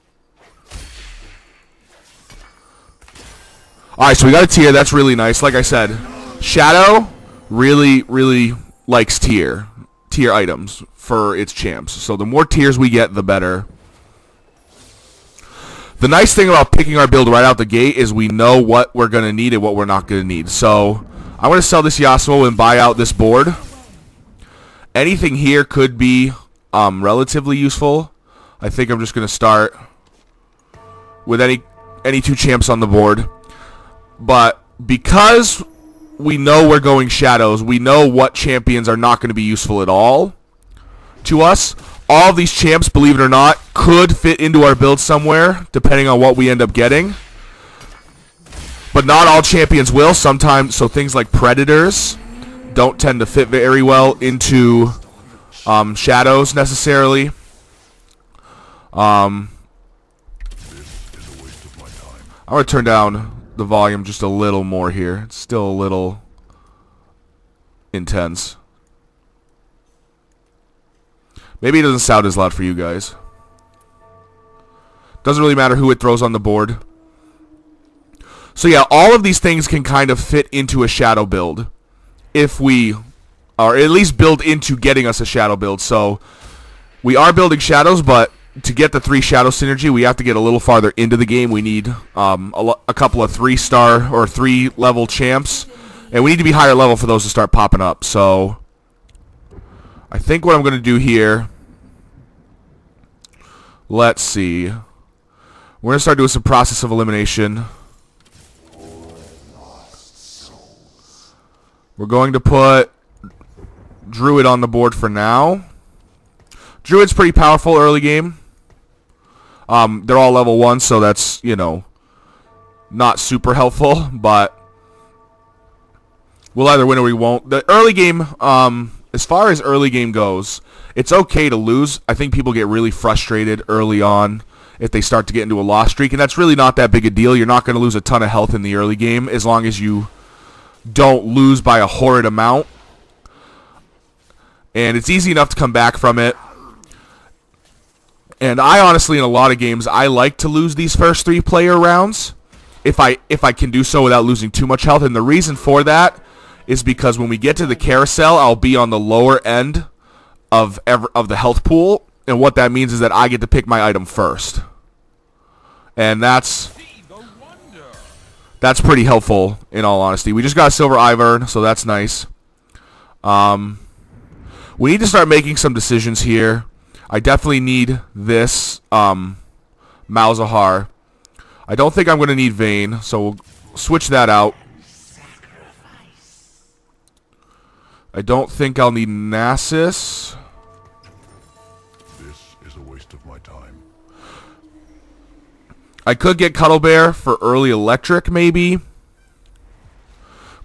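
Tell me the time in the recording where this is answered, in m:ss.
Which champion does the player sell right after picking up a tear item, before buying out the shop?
0:21.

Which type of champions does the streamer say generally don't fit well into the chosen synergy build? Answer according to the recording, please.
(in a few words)
Predators.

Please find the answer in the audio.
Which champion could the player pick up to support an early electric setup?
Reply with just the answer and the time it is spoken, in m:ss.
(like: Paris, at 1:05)
Cuddlebear, at 3:16.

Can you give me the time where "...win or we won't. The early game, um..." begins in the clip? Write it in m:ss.
2:06.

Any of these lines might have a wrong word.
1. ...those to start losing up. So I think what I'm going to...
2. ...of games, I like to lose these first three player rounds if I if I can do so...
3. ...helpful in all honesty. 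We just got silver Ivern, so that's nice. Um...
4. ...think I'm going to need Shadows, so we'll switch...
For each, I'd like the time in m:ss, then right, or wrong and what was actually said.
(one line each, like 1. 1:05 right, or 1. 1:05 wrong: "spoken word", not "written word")
1. 1:37 wrong: "popping", not "losing"
2. 2:29 right
3. 2:49 right
4. 3:01 wrong: "Vayne", not "Shadows".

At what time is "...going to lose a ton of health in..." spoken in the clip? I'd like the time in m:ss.
2:17.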